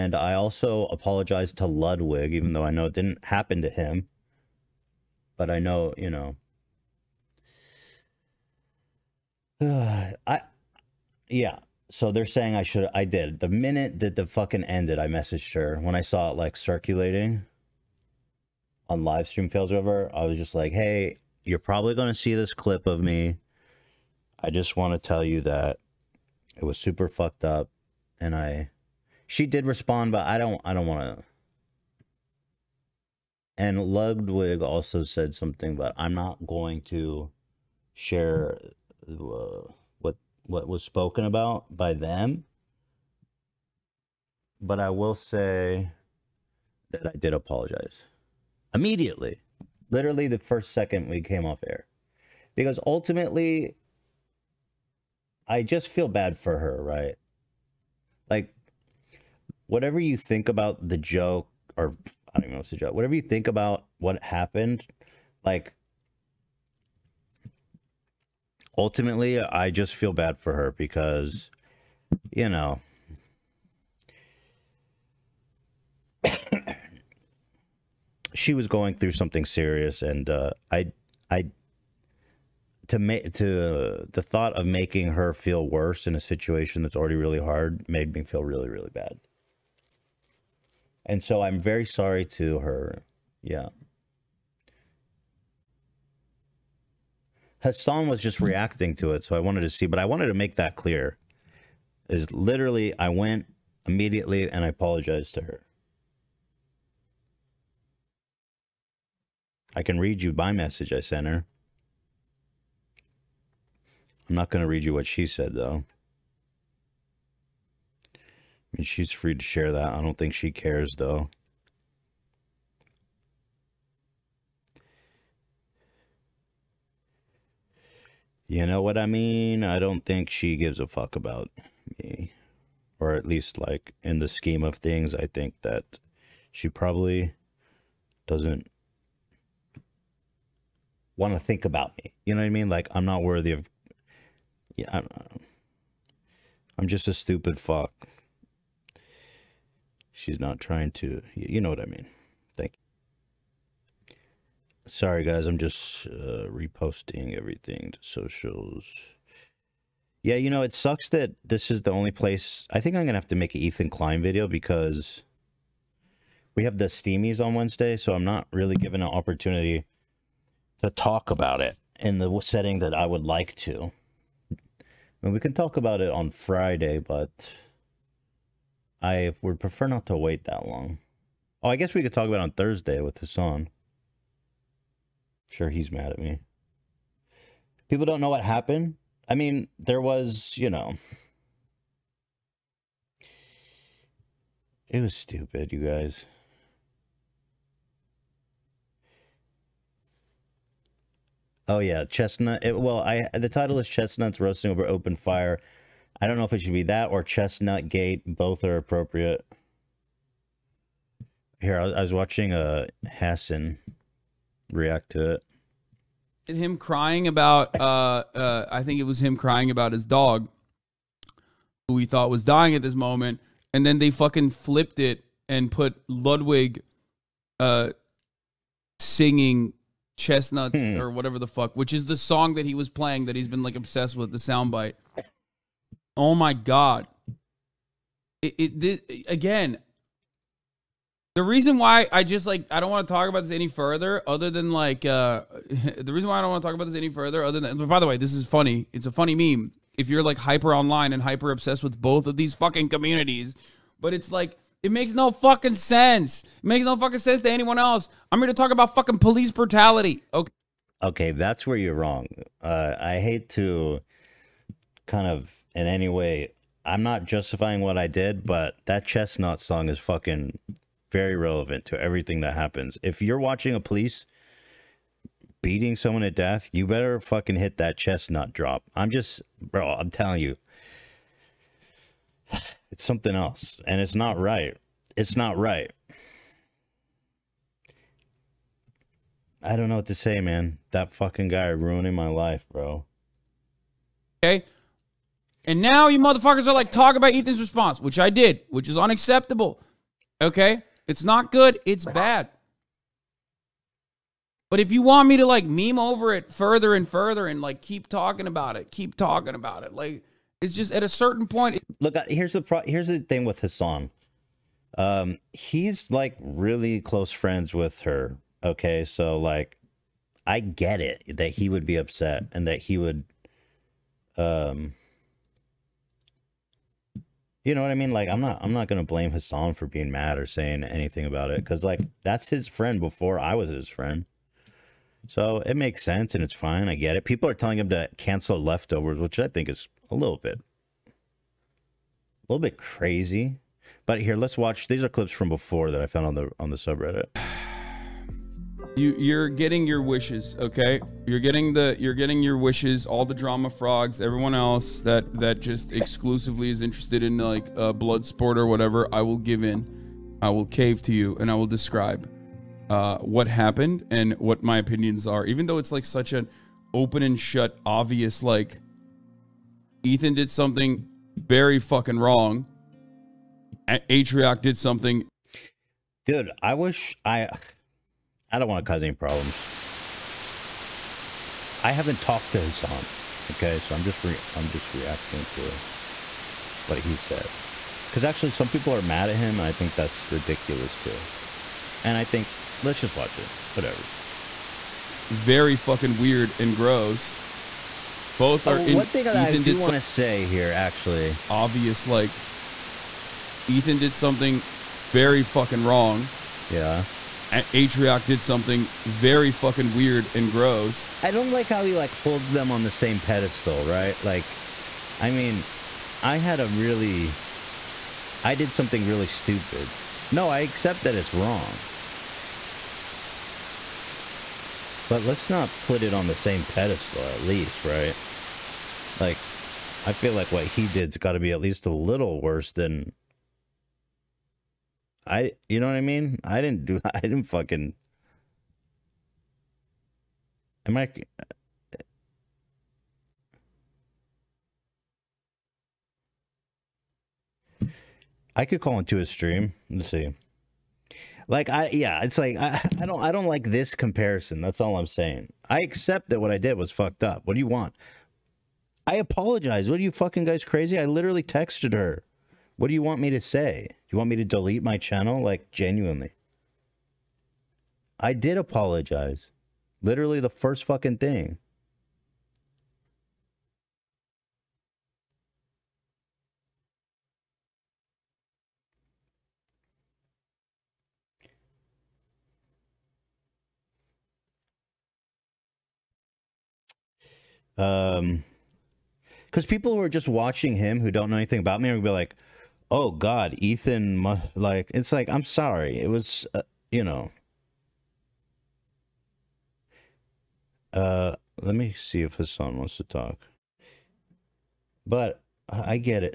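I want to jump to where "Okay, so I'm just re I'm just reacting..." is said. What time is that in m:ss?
6:23.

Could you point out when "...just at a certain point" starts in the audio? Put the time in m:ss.
5:10.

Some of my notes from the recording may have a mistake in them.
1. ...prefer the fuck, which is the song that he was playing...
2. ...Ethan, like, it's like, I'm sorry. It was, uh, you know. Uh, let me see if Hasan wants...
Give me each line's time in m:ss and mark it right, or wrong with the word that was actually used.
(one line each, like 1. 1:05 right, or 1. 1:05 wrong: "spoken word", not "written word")
1. 3:51 wrong: "whatever", not "prefer"
2. 8:13 right.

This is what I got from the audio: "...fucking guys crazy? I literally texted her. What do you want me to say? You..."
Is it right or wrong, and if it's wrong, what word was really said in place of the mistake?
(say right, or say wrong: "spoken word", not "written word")
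right.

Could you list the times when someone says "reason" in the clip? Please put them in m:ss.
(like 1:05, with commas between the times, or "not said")
4:01, 4:06.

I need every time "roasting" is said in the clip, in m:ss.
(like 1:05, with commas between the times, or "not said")
3:24.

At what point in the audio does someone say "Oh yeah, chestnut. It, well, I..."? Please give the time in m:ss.
3:21.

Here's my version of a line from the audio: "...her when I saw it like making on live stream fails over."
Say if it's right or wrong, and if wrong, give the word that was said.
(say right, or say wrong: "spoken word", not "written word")
wrong: "circulating", not "making".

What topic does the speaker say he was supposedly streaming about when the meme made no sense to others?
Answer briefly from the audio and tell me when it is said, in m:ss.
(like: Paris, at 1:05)
Police brutality, at 4:19.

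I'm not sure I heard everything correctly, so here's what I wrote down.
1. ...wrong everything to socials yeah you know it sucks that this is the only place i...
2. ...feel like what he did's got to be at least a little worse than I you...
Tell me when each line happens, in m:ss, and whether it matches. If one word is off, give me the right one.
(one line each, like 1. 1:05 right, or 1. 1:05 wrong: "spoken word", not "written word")
1. 2:36 wrong: "reposting", not "wrong"
2. 7:10 right.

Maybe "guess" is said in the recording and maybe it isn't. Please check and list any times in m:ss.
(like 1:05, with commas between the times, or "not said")
3:01.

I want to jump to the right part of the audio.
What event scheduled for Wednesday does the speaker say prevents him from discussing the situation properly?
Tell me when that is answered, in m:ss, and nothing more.
2:46.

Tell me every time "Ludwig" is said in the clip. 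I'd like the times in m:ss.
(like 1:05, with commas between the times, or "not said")
0:01, 0:33, 3:46.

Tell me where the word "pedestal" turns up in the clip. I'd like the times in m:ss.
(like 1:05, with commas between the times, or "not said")
6:53, 7:06.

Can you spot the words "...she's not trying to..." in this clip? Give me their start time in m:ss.
2:30.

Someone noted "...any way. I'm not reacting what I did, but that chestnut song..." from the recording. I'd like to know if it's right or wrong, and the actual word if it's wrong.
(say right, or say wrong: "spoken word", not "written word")
wrong: "justifying", not "reacting".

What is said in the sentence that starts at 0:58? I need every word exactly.
Like whatever you think about the joke or I don't even know what to joke.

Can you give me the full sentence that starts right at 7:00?
No, I accept that it's wrong.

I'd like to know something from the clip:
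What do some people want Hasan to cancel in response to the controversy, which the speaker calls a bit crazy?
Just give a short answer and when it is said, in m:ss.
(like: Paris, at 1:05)
Leftovers, at 5:38.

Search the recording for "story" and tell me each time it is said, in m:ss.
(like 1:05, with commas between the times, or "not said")
not said.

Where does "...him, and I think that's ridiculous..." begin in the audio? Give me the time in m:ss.
6:29.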